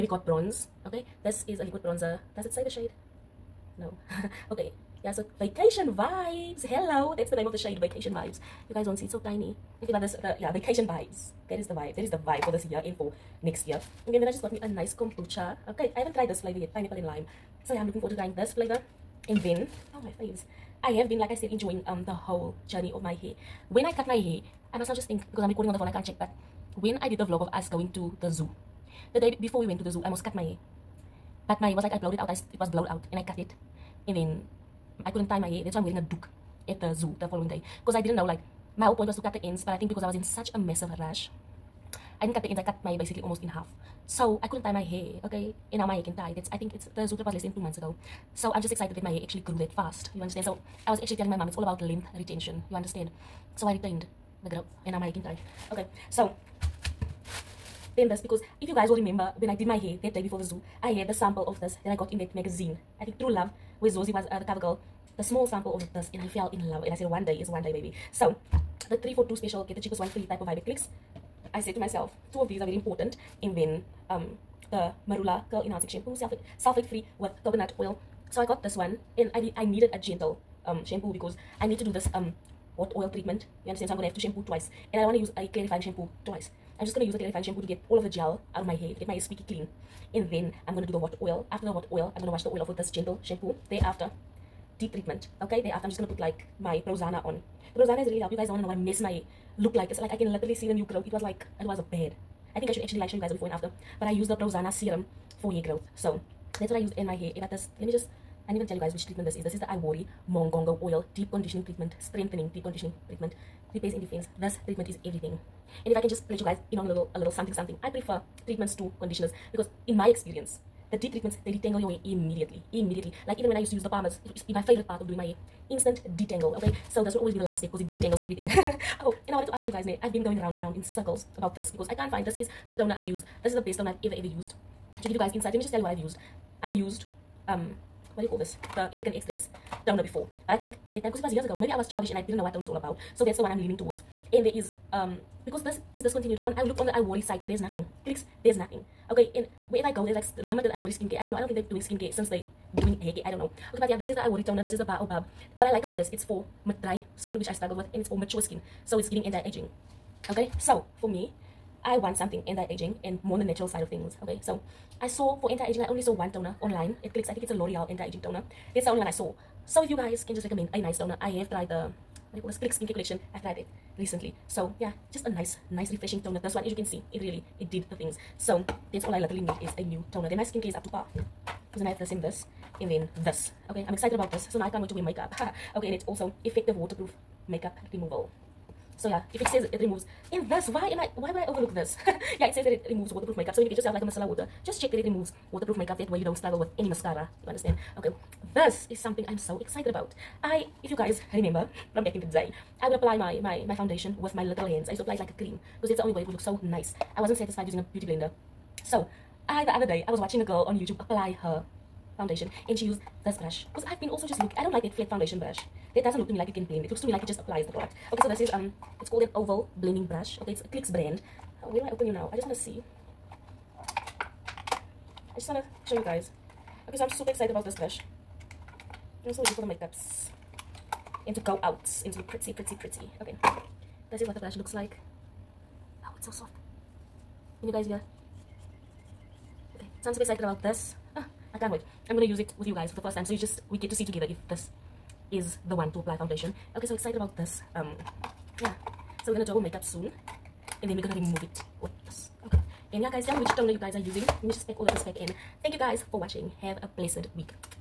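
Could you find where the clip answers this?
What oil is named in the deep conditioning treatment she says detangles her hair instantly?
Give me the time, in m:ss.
1:50.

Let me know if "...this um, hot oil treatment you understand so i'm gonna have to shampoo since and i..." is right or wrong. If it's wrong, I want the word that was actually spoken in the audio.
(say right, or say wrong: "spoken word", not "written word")
wrong: "twice", not "since".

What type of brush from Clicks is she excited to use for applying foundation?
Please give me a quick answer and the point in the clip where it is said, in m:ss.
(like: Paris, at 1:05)
Oval blending brush, at 3:39.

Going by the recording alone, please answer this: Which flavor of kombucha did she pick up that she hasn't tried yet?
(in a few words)
Pineapple and lime.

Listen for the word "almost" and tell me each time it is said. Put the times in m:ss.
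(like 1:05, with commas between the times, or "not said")
0:30, 0:43.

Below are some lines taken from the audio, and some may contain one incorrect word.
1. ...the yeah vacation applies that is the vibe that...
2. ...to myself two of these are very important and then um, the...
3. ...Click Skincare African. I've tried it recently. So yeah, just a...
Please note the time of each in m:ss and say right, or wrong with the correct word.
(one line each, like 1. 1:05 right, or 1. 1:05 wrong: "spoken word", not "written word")
1. 0:10 wrong: "vibes", not "applies"
2. 1:11 right
3. 2:52 wrong: "Collection", not "African".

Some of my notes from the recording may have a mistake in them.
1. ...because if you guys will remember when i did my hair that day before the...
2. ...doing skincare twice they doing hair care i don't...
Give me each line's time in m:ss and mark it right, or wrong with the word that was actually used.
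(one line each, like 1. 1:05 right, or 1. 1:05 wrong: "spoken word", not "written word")
1. 0:58 right
2. 2:31 wrong: "since", not "twice".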